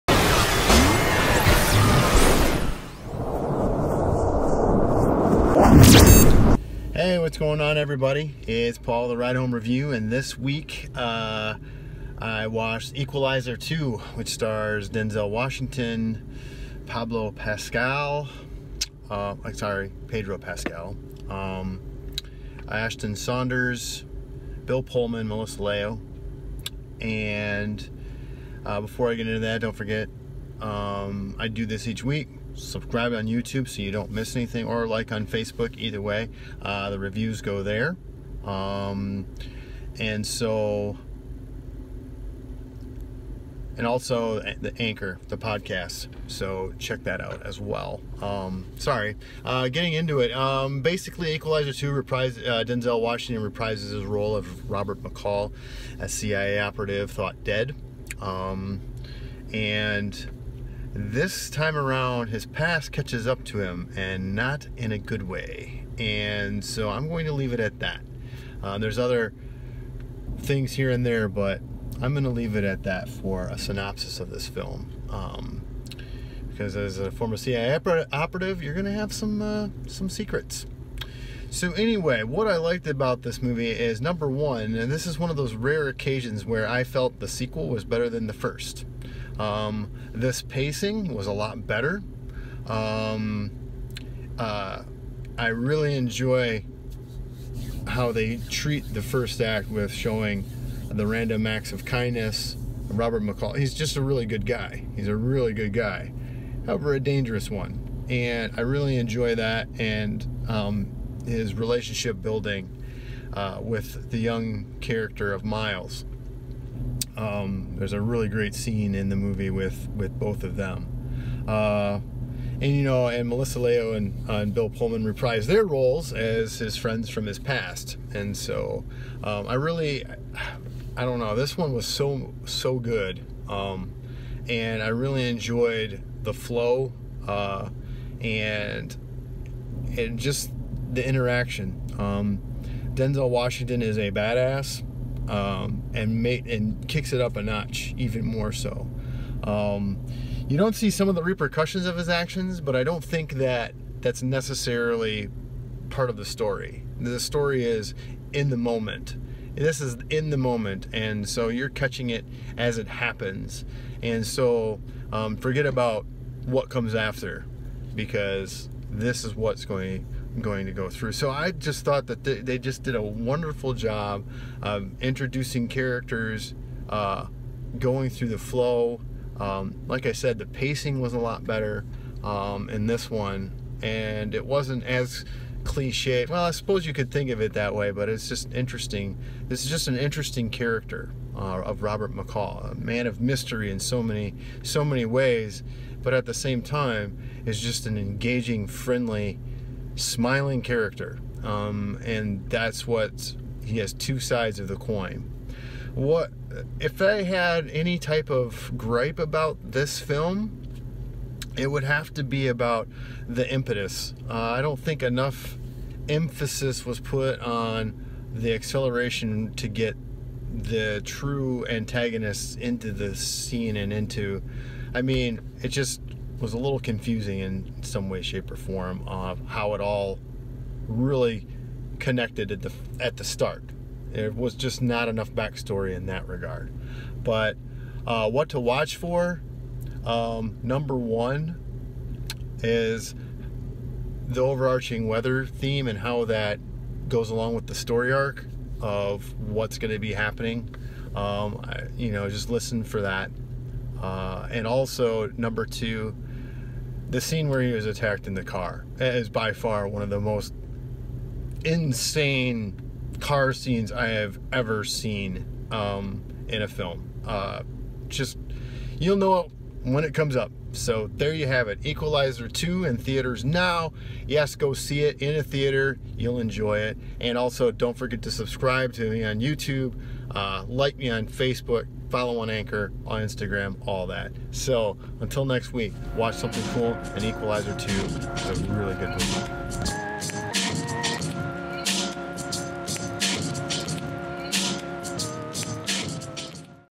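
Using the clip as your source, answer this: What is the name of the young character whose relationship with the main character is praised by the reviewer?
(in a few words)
Miles.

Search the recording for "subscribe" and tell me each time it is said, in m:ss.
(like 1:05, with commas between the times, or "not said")
0:32, 4:38.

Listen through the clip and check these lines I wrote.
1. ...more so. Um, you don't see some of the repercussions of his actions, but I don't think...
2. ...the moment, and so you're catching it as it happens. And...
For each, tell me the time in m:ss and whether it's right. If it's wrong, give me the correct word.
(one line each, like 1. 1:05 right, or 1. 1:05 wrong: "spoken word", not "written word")
1. 2:28 right
2. 2:40 right.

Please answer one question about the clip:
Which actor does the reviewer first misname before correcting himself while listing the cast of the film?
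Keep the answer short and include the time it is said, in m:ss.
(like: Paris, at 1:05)
Pedro Pascal, at 0:20.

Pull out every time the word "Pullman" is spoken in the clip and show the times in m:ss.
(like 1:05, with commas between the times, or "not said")
0:24, 2:04.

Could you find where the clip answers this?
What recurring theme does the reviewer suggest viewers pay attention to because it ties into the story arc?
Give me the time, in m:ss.
4:05.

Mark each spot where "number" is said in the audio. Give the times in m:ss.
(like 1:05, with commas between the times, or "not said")
1:23, 4:00, 4:15.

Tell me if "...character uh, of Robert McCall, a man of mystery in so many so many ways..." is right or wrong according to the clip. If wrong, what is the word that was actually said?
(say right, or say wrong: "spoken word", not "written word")
right.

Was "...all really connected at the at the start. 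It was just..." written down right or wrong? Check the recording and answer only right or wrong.
right.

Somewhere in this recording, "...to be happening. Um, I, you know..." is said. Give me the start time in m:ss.
4:09.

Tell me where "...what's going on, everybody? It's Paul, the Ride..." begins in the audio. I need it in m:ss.
0:07.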